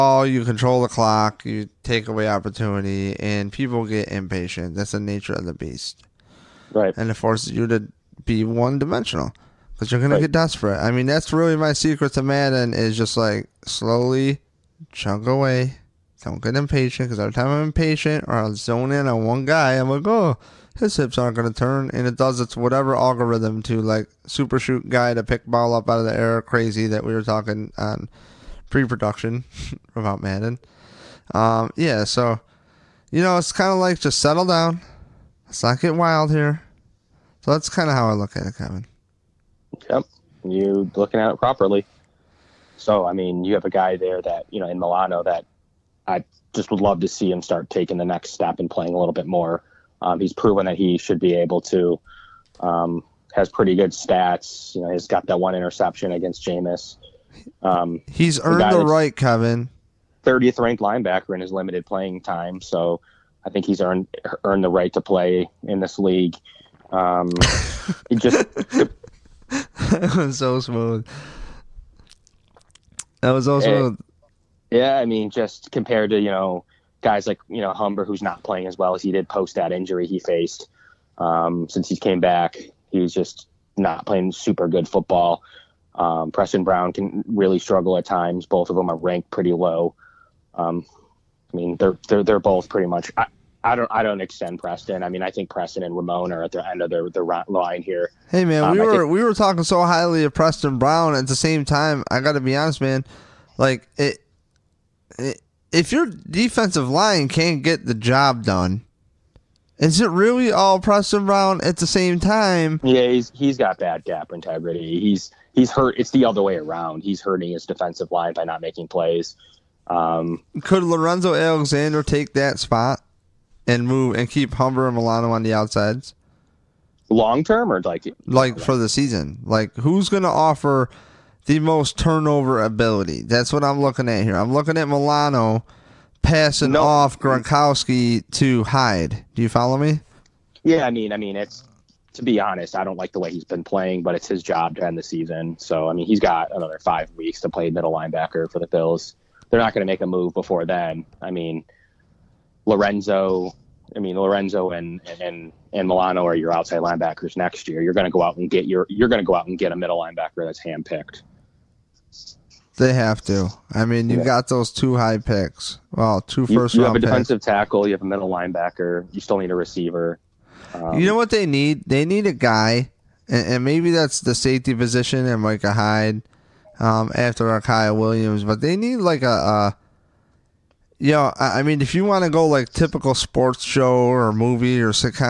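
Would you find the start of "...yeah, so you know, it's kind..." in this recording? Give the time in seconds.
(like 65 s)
31 s.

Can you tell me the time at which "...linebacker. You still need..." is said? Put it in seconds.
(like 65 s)
168 s.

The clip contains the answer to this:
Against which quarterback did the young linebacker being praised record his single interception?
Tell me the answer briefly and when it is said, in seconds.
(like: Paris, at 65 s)
Jameis, at 56 s.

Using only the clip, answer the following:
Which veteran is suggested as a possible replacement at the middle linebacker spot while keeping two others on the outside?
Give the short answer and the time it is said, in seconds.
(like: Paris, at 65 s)
Lorenzo Alexander, at 120 s.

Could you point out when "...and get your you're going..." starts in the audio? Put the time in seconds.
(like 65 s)
158 s.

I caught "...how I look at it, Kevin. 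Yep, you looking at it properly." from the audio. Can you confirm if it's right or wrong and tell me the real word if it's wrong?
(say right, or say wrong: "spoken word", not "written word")
right.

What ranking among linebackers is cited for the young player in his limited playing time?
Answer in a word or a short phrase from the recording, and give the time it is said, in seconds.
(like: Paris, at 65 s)
30th, at 60 s.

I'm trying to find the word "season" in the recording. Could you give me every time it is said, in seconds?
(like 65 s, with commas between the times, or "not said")
128 s, 145 s.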